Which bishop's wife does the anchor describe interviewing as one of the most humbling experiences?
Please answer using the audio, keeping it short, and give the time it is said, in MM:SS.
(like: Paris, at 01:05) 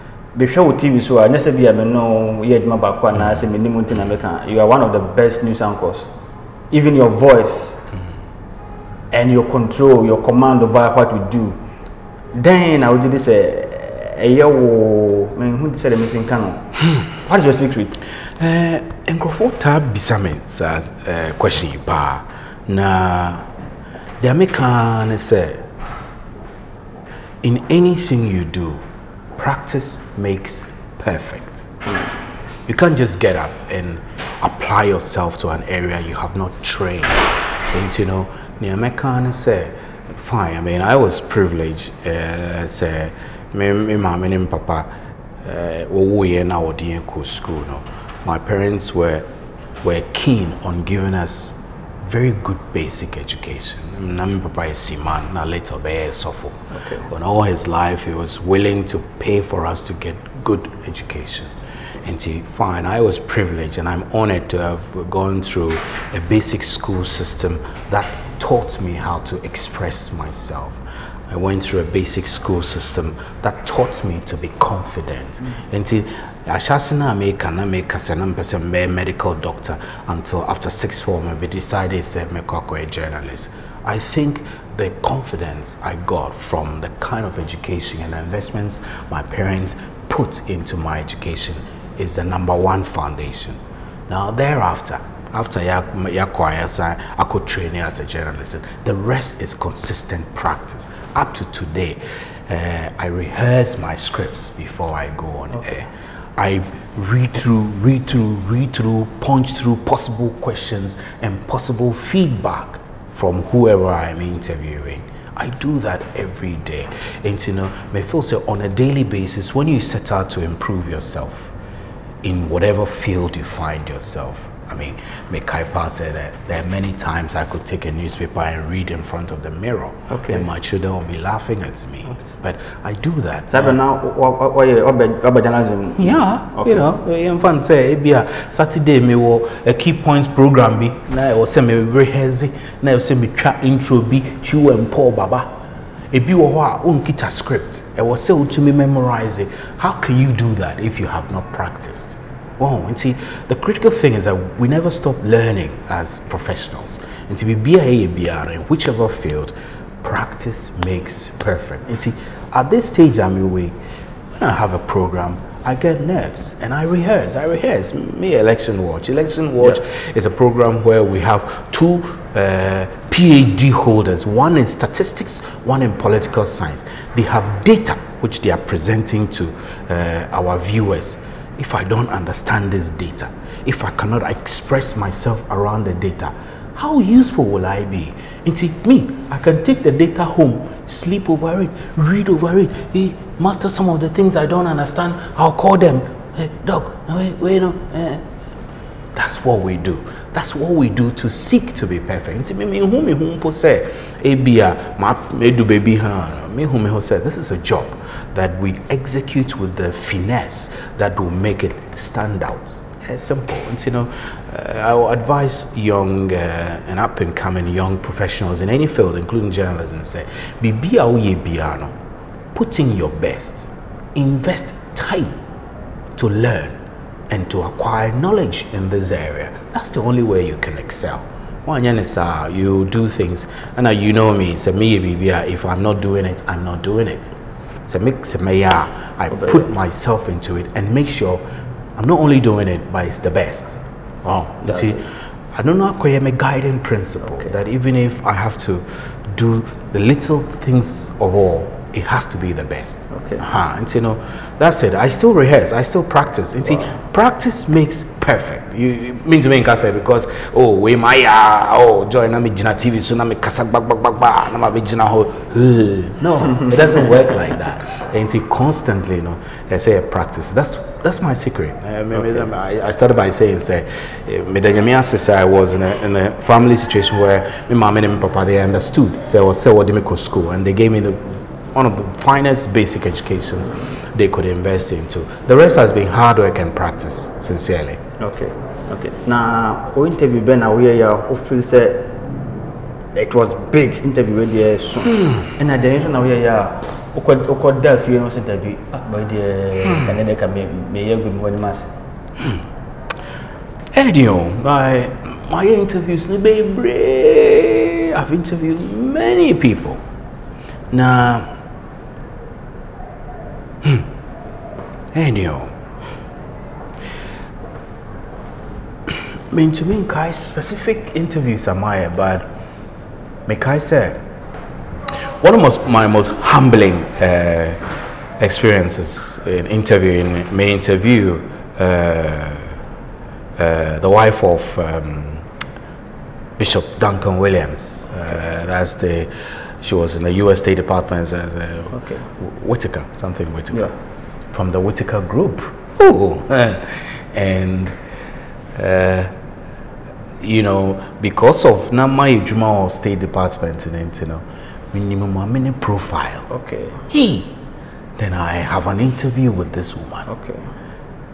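Duncan Williams, at 05:36.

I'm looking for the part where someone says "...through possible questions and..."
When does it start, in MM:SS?
01:49.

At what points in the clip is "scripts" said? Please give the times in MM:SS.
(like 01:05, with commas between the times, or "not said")
01:43, 02:27.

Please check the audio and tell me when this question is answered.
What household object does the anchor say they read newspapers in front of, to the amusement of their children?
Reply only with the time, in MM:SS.
02:09.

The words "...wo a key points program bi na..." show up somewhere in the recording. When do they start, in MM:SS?
02:19.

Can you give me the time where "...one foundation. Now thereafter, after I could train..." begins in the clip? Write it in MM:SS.
01:32.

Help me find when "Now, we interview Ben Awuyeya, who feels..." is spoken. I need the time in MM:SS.
04:49.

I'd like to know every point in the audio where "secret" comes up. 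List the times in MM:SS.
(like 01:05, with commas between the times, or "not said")
00:17, 04:31.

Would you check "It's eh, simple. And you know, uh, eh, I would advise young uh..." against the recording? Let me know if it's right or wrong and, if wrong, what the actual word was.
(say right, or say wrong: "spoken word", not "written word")
right.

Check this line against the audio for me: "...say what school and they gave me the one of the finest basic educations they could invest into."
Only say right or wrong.
right.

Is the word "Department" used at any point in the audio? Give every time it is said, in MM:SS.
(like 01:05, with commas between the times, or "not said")
05:40, 05:53.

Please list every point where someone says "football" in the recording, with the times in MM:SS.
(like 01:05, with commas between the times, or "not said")
not said.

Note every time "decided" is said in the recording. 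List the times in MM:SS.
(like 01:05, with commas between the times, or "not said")
01:21.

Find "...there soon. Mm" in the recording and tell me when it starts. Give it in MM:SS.
04:54.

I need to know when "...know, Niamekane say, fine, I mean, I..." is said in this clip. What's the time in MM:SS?
00:38.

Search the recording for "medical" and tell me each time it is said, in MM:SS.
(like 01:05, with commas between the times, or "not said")
01:18.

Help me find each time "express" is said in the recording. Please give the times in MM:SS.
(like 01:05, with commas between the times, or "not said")
01:09, 03:04.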